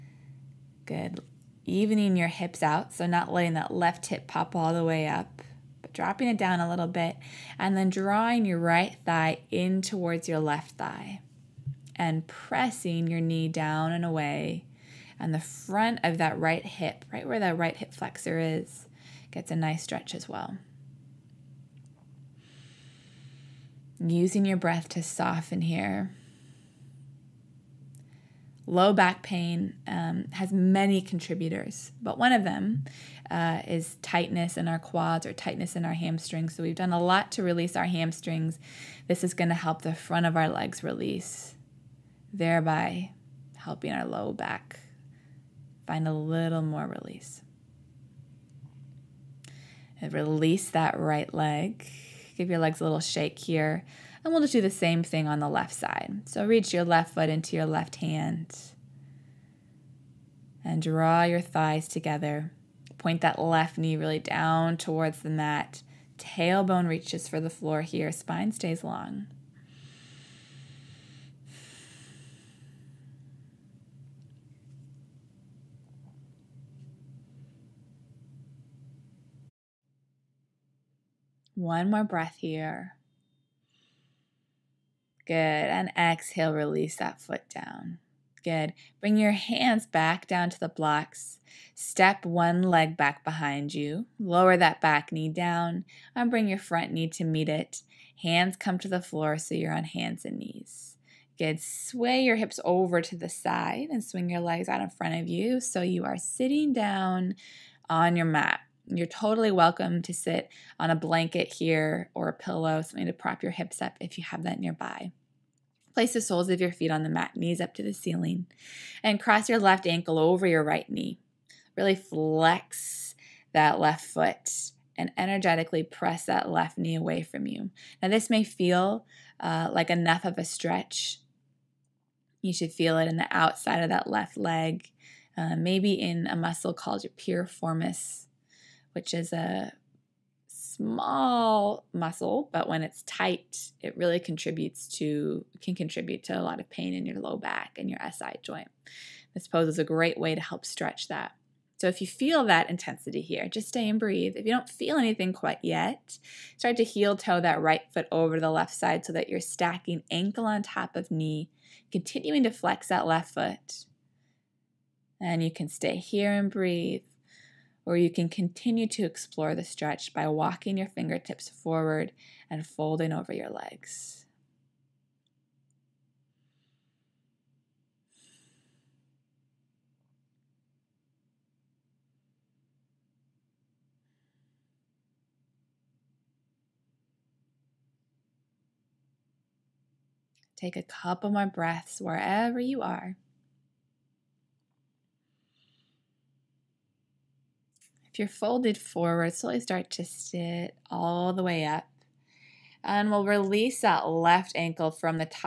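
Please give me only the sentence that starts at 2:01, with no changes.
Really flex that left foot and energetically press that left knee away from you.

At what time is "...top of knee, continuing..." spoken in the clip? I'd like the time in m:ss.
2:40.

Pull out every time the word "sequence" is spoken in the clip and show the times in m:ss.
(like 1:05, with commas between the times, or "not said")
not said.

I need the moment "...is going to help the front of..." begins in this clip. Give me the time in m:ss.
0:39.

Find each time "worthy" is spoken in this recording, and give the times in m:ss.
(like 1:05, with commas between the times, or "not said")
not said.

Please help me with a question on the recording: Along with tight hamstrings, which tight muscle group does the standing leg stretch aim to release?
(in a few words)
quads.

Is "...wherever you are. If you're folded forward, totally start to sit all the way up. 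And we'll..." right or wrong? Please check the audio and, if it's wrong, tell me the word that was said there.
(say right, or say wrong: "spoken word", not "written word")
wrong: "slowly", not "totally".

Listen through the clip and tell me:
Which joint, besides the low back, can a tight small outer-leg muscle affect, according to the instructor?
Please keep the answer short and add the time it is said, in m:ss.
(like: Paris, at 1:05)
SI joint, at 2:28.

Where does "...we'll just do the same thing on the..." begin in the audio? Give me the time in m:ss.
0:54.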